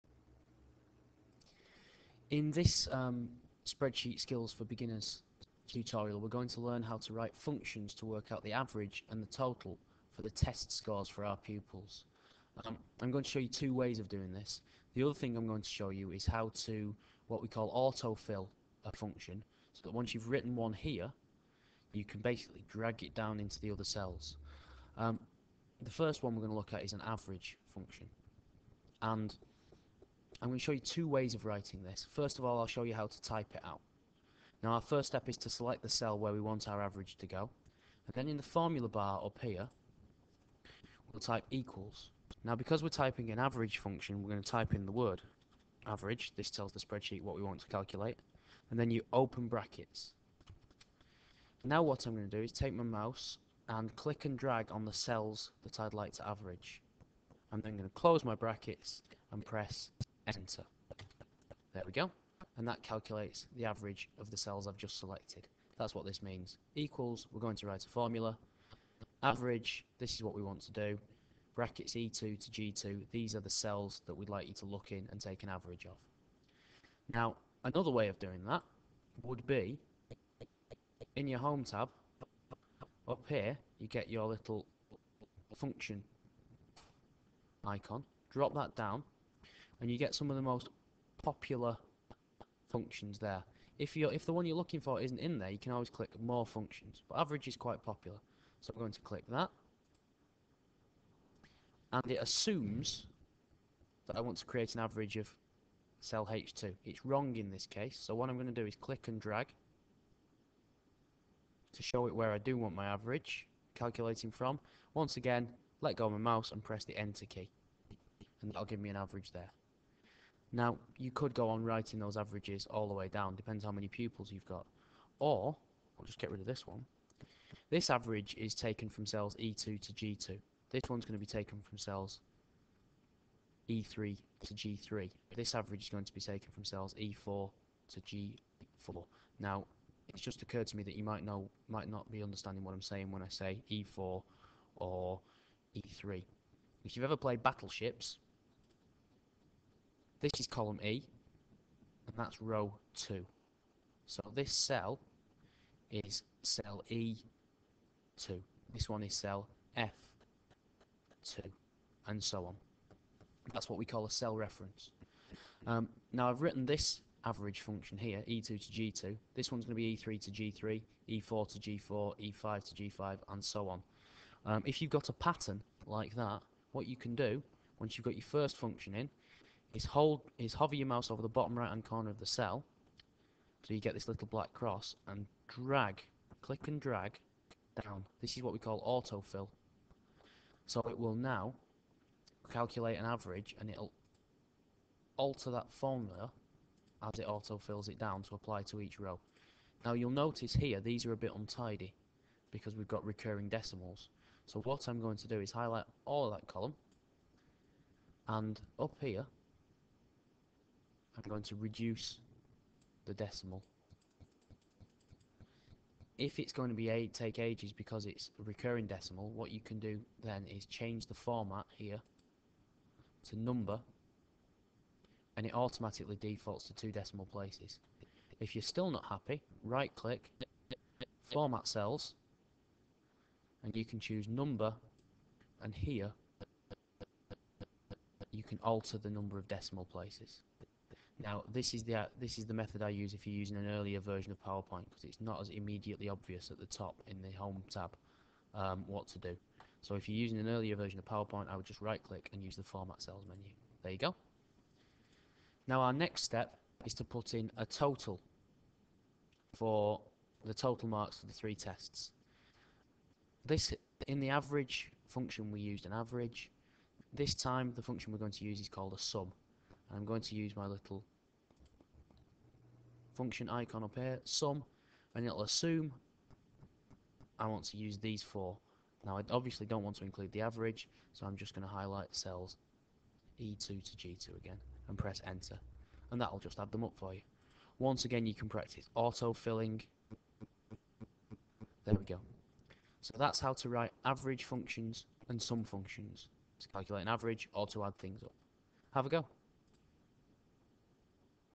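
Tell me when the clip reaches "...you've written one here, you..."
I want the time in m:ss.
0:20.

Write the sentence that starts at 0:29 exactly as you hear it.
And I'm going to show you two ways of writing this.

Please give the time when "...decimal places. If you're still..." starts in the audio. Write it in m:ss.
3:46.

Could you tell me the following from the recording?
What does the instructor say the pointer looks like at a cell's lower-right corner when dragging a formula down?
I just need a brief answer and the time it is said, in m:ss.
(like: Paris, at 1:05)
little black cross, at 3:04.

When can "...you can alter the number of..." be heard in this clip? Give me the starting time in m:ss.
3:58.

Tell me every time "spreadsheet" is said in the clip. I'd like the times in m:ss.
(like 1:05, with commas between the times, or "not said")
0:03, 0:46.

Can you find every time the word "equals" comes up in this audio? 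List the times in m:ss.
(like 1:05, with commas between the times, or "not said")
0:41, 1:06.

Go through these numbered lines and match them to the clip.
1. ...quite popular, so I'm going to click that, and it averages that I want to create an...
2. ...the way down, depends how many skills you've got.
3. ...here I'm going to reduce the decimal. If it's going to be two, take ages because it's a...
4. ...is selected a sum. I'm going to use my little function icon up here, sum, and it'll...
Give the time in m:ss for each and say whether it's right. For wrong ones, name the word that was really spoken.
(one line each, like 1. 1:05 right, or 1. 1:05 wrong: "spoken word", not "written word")
1. 1:37 wrong: "assumes", not "averages"
2. 2:02 wrong: "pupils", not "skills"
3. 3:28 wrong: "eight", not "two"
4. 4:28 wrong: "called", not "selected".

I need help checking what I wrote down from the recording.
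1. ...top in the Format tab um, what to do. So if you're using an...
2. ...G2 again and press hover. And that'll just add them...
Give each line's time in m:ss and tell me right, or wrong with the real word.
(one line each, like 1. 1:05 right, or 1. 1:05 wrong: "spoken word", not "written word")
1. 4:06 wrong: "Home", not "Format"
2. 4:44 wrong: "enter", not "hover".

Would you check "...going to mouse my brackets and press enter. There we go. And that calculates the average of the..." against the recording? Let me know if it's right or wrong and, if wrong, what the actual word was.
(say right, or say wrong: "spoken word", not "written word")
wrong: "close", not "mouse".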